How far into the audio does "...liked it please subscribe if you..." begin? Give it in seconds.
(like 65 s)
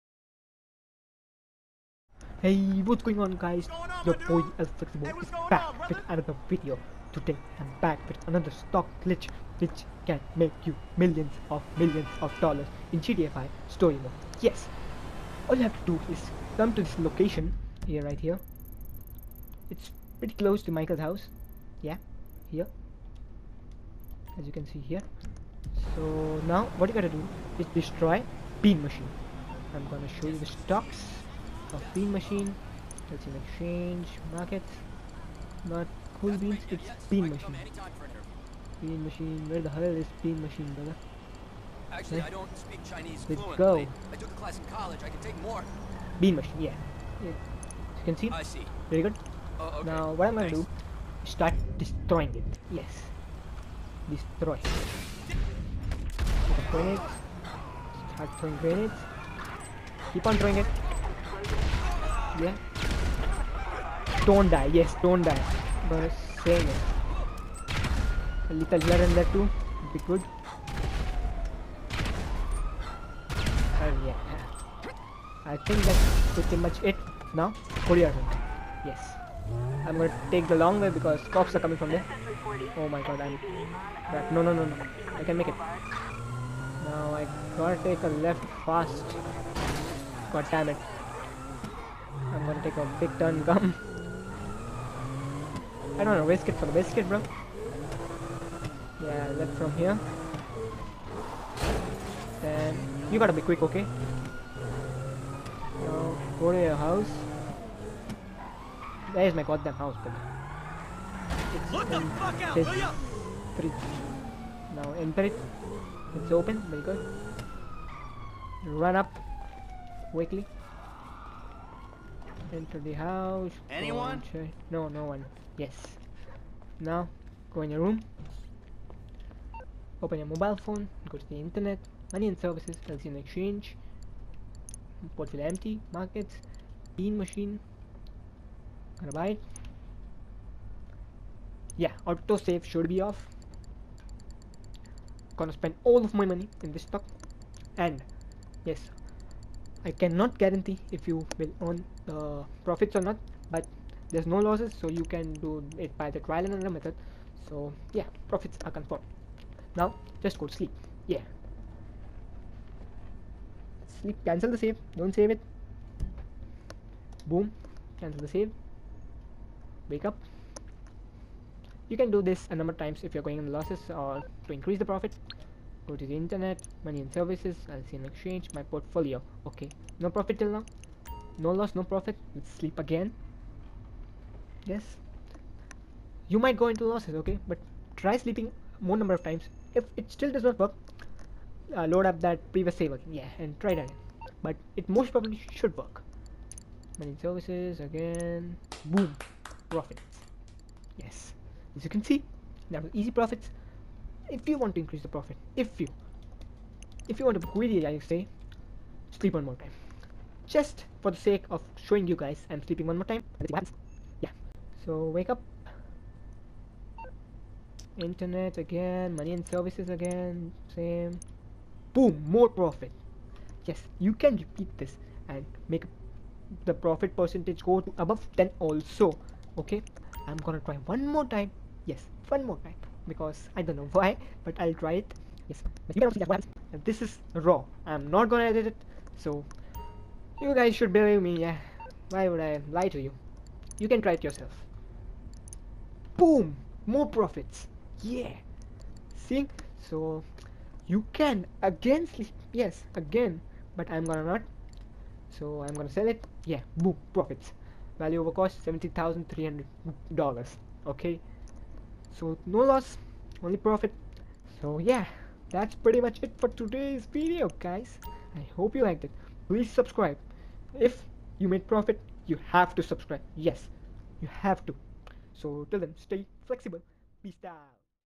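268 s.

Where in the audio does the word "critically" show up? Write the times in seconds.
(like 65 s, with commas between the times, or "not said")
not said.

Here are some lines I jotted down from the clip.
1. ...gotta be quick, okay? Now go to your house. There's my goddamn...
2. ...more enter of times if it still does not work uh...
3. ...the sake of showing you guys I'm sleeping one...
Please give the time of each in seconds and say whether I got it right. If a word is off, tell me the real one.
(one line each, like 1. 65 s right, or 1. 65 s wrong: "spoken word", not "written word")
1. 103 s right
2. 188 s wrong: "number", not "enter"
3. 211 s right.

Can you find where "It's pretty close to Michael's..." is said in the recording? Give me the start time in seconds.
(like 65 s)
19 s.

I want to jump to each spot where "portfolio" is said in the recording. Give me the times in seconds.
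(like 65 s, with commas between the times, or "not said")
135 s, 178 s.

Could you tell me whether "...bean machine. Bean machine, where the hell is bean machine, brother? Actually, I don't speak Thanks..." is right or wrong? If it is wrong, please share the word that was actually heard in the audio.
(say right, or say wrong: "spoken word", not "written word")
wrong: "Chinese", not "Thanks".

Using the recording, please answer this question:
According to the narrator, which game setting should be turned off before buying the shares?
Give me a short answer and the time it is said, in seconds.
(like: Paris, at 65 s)
Autosave, at 142 s.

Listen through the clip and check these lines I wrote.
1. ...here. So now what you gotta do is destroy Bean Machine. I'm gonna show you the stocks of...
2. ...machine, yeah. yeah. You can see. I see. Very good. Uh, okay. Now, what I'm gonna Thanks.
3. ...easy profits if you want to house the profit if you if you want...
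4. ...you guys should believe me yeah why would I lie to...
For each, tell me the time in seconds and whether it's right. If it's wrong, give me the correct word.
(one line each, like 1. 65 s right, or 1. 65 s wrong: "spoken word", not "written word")
1. 24 s right
2. 46 s right
3. 202 s wrong: "increase", not "house"
4. 240 s right.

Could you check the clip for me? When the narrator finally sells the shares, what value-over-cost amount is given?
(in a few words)
$70,300.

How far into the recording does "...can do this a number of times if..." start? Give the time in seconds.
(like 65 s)
171 s.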